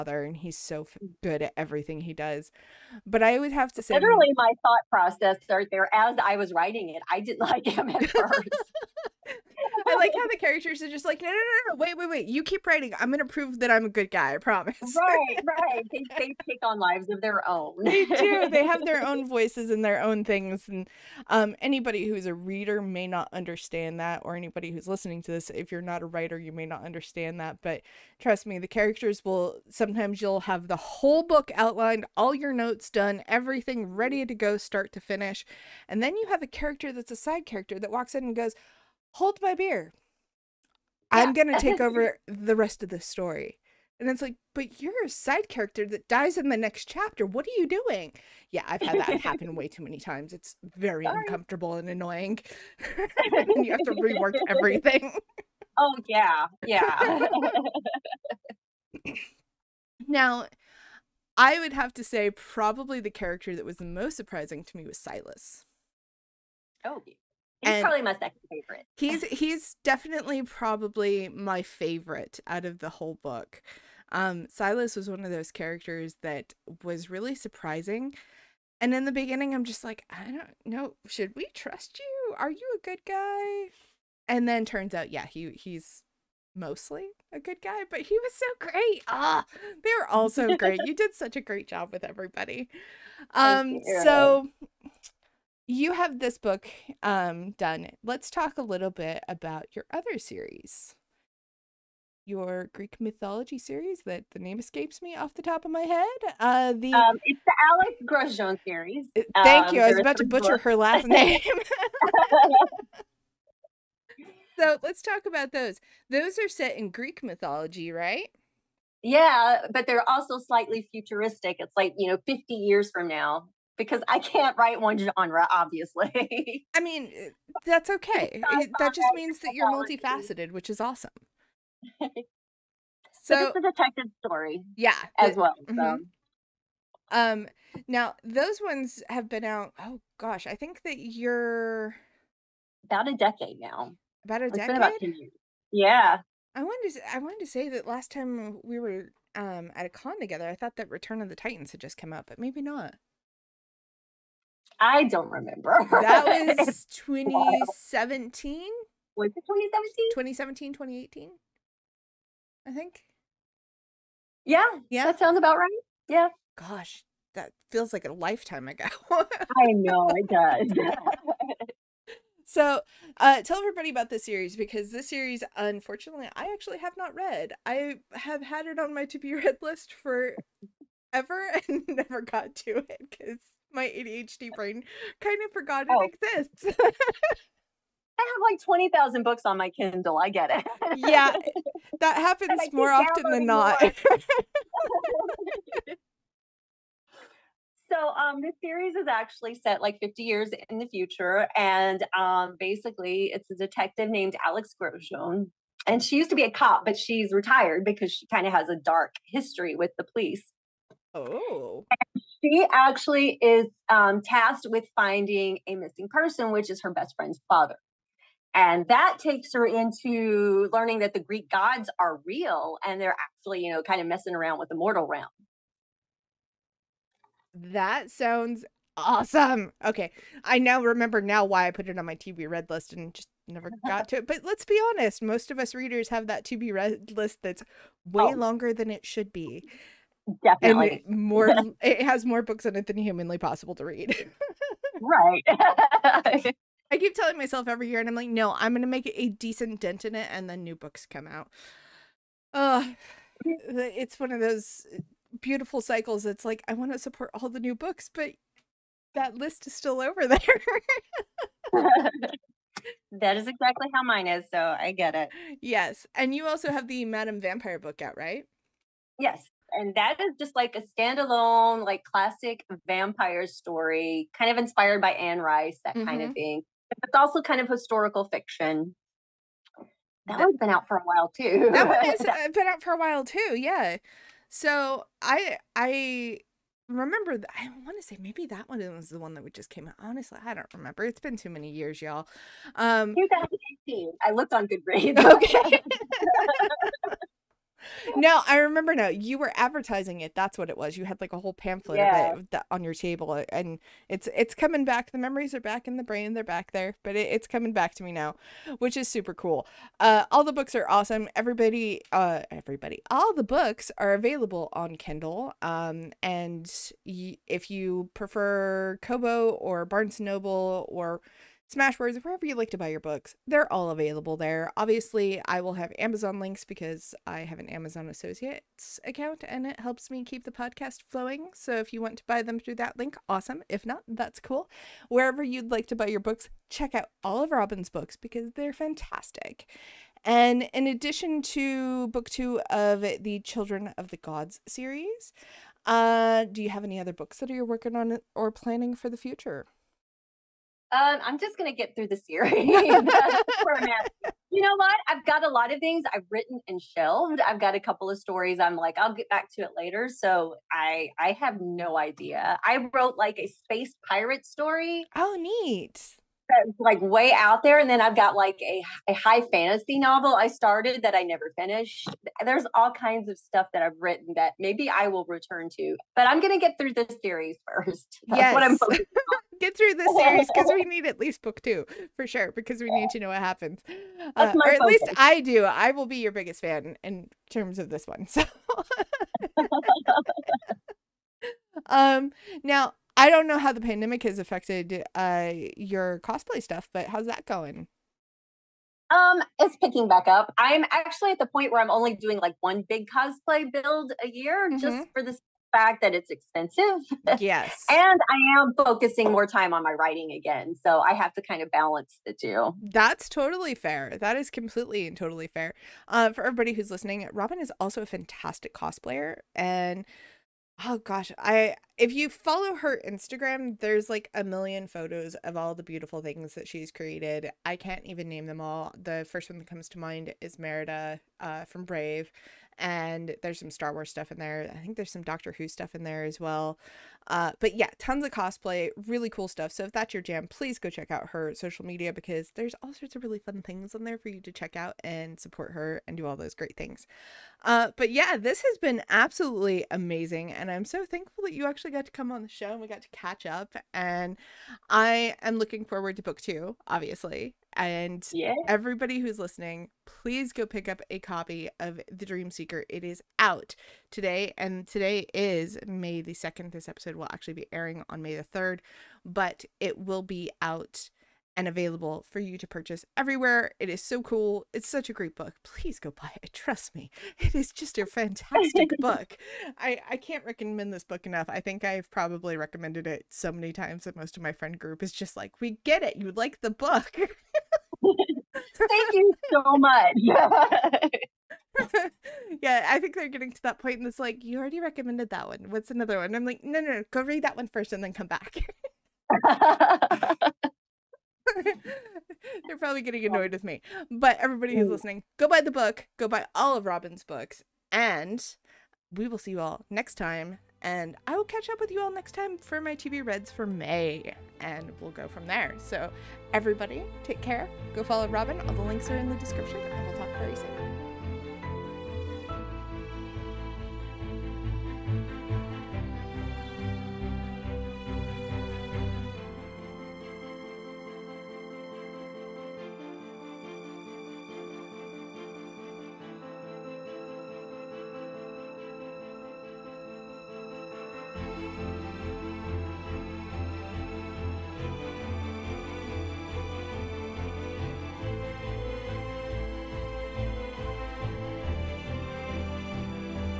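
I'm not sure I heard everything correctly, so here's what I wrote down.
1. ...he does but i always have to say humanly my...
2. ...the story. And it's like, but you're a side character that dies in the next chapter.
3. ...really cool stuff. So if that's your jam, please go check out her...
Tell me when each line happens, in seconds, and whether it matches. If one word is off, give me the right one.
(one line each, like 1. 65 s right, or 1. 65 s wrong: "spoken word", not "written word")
1. 2 s wrong: "literally", not "humanly"
2. 42 s right
3. 439 s right.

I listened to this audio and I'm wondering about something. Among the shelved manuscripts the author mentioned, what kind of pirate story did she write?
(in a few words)
space pirate story.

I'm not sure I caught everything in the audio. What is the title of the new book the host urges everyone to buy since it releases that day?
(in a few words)
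The Dream Seeker.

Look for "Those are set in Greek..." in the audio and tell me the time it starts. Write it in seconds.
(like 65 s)
116 s.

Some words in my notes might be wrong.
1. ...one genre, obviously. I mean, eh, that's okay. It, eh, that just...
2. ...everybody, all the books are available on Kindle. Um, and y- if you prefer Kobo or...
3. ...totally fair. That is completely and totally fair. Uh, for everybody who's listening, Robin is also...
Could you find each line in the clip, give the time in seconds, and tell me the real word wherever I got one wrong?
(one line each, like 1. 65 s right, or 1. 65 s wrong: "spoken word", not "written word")
1. 124 s right
2. 312 s right
3. 413 s right.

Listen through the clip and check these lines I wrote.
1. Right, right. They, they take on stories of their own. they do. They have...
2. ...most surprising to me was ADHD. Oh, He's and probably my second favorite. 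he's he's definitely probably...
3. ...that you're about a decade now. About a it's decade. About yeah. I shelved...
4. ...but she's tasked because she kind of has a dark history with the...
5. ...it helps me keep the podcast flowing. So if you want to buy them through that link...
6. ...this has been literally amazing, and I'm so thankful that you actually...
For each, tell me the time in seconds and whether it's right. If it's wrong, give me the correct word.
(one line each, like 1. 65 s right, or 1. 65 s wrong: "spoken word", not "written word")
1. 14 s wrong: "lives", not "stories"
2. 63 s wrong: "Silas", not "ADHD"
3. 140 s wrong: "wanted", not "shelved"
4. 206 s wrong: "retired", not "tasked"
5. 329 s right
6. 448 s wrong: "absolutely", not "literally".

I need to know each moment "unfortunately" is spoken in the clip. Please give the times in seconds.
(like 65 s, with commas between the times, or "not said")
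175 s.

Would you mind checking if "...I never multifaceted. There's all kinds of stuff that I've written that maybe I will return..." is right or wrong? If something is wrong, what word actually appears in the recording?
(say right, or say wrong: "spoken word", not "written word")
wrong: "finished", not "multifaceted".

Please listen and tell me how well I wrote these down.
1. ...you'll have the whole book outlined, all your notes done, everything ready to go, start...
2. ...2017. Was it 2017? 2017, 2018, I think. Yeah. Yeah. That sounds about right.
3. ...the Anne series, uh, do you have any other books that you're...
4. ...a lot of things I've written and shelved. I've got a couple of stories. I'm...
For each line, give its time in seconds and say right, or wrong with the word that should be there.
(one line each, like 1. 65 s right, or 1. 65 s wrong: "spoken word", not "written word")
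1. 30 s right
2. 156 s right
3. 344 s wrong: "Gods", not "Anne"
4. 355 s right.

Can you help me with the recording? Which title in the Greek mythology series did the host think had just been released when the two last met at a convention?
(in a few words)
Return of the Titans.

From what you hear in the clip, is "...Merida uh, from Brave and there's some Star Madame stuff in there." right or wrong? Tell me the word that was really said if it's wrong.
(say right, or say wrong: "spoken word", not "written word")
wrong: "Wars", not "Madame".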